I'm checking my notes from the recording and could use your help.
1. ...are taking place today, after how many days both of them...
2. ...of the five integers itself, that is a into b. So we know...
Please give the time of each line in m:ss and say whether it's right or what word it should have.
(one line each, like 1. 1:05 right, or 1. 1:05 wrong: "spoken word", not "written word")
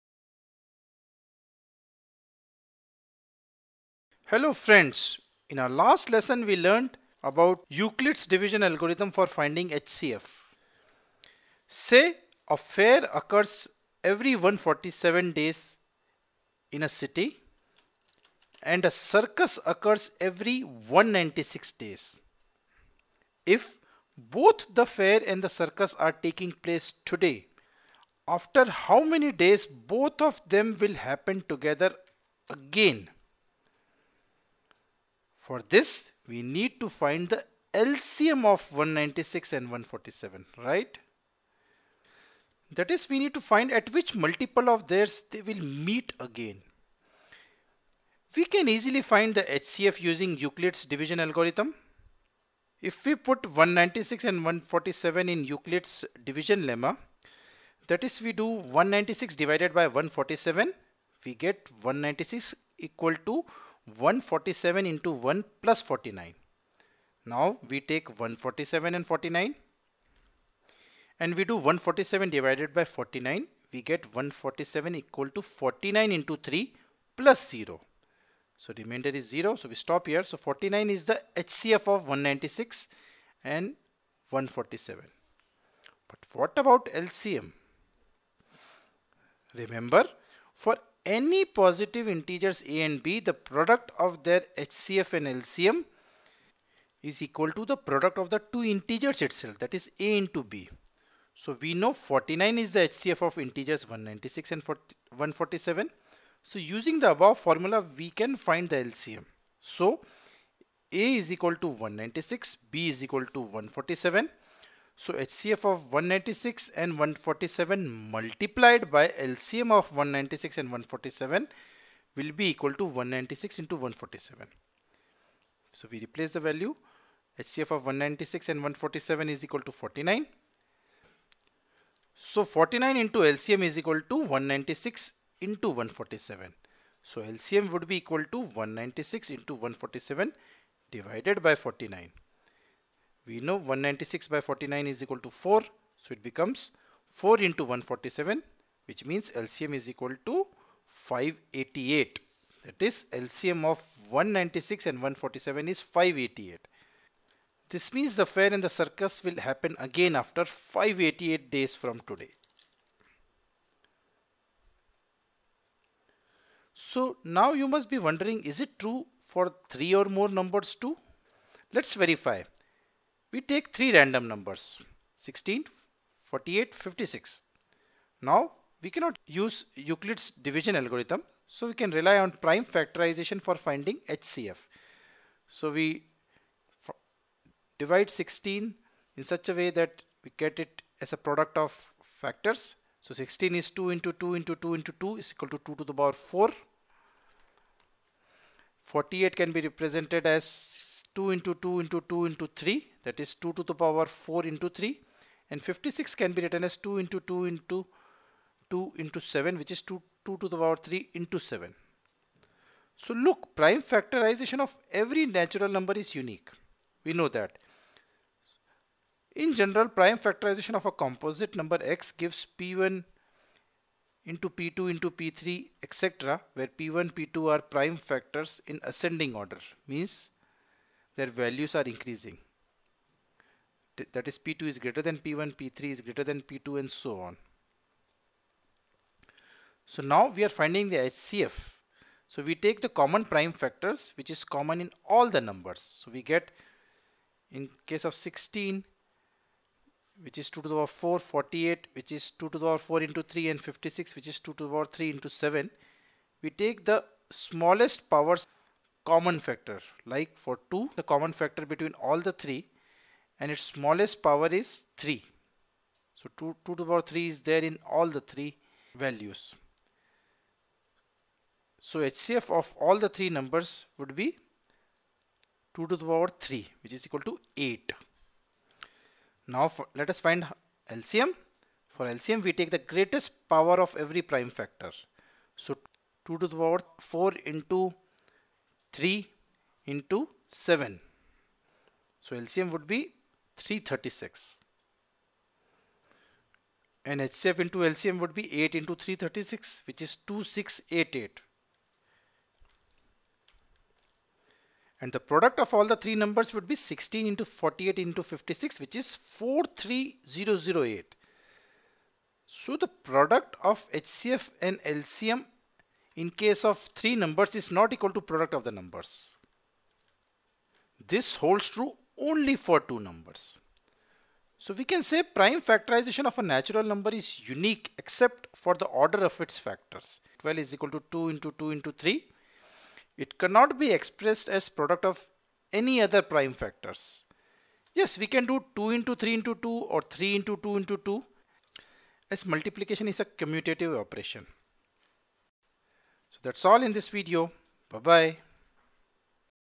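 1. 0:25 right
2. 1:38 wrong: "two", not "five".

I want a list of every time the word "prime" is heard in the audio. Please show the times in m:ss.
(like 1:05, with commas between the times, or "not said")
3:02, 3:33, 3:39, 3:47, 4:03, 4:44, 5:25, 5:36.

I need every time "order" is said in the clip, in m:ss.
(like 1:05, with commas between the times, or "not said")
3:49, 5:28.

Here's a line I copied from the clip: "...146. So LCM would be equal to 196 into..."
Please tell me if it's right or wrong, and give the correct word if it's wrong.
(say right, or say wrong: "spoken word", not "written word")
wrong: "147", not "146".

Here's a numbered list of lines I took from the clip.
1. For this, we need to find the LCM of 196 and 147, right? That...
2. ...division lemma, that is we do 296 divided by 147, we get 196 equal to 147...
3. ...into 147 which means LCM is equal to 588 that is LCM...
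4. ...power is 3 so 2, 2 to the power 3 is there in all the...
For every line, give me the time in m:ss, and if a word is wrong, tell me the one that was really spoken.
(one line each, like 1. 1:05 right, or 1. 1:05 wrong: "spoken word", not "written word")
1. 0:35 right
2. 0:56 wrong: "196", not "296"
3. 2:27 right
4. 4:24 right.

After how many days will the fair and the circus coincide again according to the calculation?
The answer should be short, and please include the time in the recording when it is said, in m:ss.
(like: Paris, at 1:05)
588 days, at 2:40.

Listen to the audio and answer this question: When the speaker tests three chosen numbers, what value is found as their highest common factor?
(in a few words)
8.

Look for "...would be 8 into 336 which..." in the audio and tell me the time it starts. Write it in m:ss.
4:58.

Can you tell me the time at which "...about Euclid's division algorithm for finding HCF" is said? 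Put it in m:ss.
0:07.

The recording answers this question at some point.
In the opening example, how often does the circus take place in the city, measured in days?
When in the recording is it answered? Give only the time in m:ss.
0:20.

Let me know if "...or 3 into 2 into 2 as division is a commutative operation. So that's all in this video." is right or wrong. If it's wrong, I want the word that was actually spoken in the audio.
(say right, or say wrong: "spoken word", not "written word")
wrong: "multiplication", not "division".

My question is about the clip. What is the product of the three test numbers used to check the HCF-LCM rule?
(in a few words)
43008.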